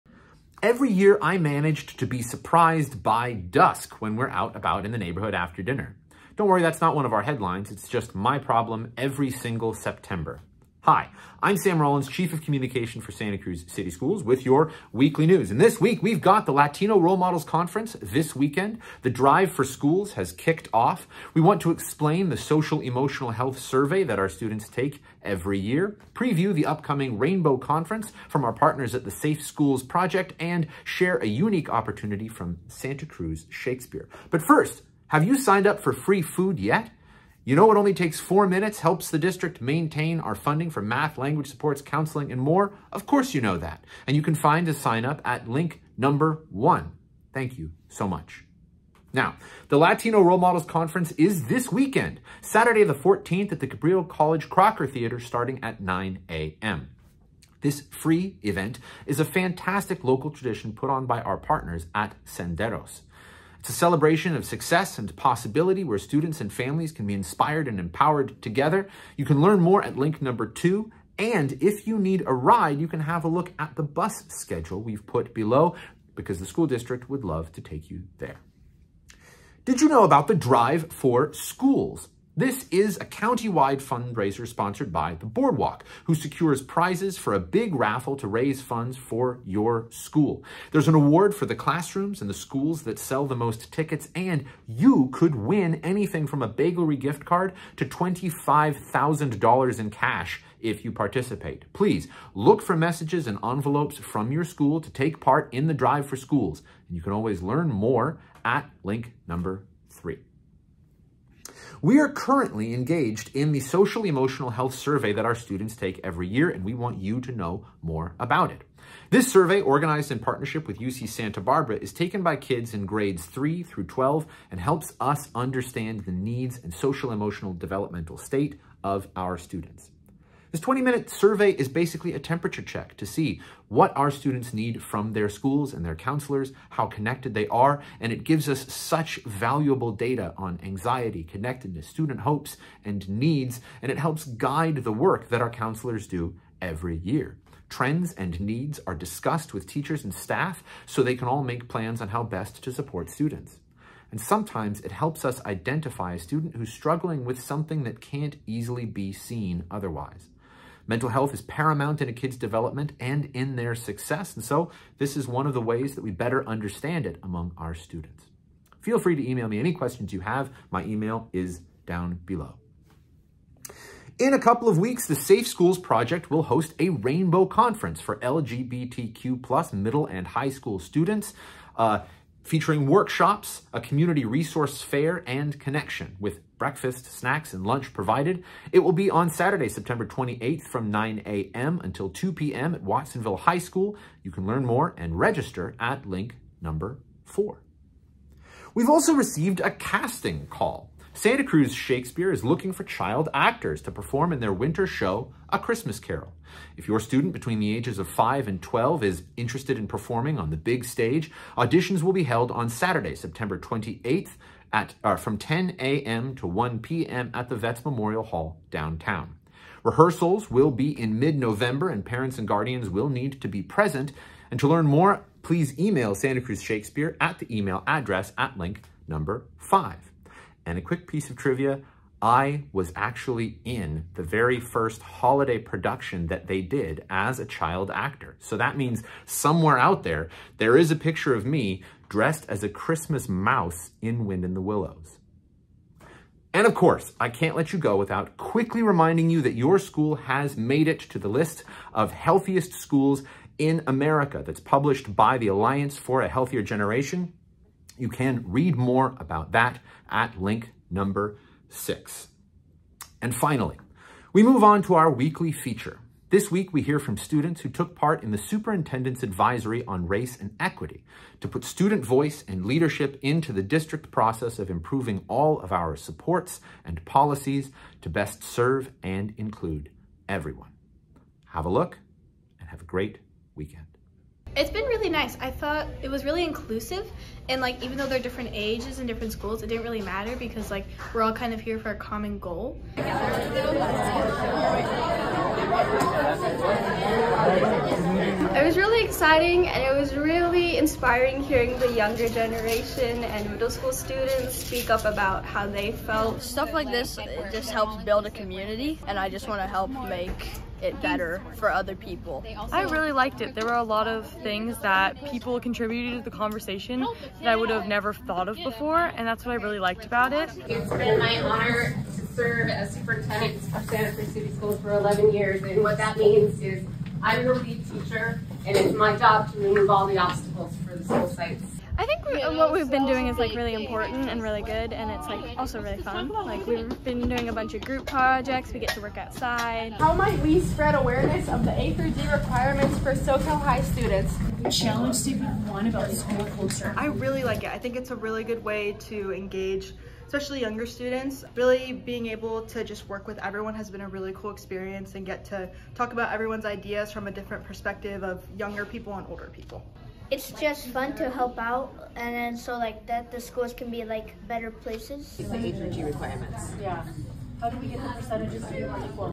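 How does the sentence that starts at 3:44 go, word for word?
And to learn more, please email Santa Cruz Shakespeare at the email address at link number 5.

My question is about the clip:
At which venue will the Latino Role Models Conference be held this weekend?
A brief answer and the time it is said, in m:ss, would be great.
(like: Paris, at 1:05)
Cabrillo College Crocker Theater, at 0:53.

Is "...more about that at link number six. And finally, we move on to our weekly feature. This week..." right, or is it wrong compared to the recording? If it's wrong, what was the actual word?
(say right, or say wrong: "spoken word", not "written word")
right.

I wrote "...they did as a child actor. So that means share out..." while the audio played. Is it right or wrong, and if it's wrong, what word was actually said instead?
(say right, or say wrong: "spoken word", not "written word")
wrong: "somewhere", not "share".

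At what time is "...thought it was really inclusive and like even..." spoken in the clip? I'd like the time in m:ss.
4:45.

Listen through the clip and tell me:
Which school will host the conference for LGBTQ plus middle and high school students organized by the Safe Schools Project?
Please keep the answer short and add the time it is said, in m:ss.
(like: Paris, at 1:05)
Watsonville High School, at 3:12.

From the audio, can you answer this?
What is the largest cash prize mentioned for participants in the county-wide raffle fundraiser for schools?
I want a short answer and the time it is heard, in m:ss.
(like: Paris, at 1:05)
$25,000, at 1:37.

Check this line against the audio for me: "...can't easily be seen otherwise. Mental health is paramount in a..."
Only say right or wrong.
right.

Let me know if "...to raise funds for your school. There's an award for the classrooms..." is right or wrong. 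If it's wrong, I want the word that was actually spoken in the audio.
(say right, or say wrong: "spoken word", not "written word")
right.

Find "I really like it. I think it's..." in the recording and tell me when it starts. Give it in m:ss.
5:46.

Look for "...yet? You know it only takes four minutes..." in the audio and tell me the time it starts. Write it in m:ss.
0:36.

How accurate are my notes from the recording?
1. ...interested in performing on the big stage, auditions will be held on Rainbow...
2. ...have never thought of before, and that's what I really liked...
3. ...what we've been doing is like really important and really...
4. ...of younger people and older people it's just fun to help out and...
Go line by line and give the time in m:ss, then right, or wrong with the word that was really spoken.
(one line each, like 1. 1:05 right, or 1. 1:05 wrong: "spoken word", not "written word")
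1. 3:29 wrong: "Saturday", not "Rainbow"
2. 5:17 right
3. 5:32 right
4. 5:58 right.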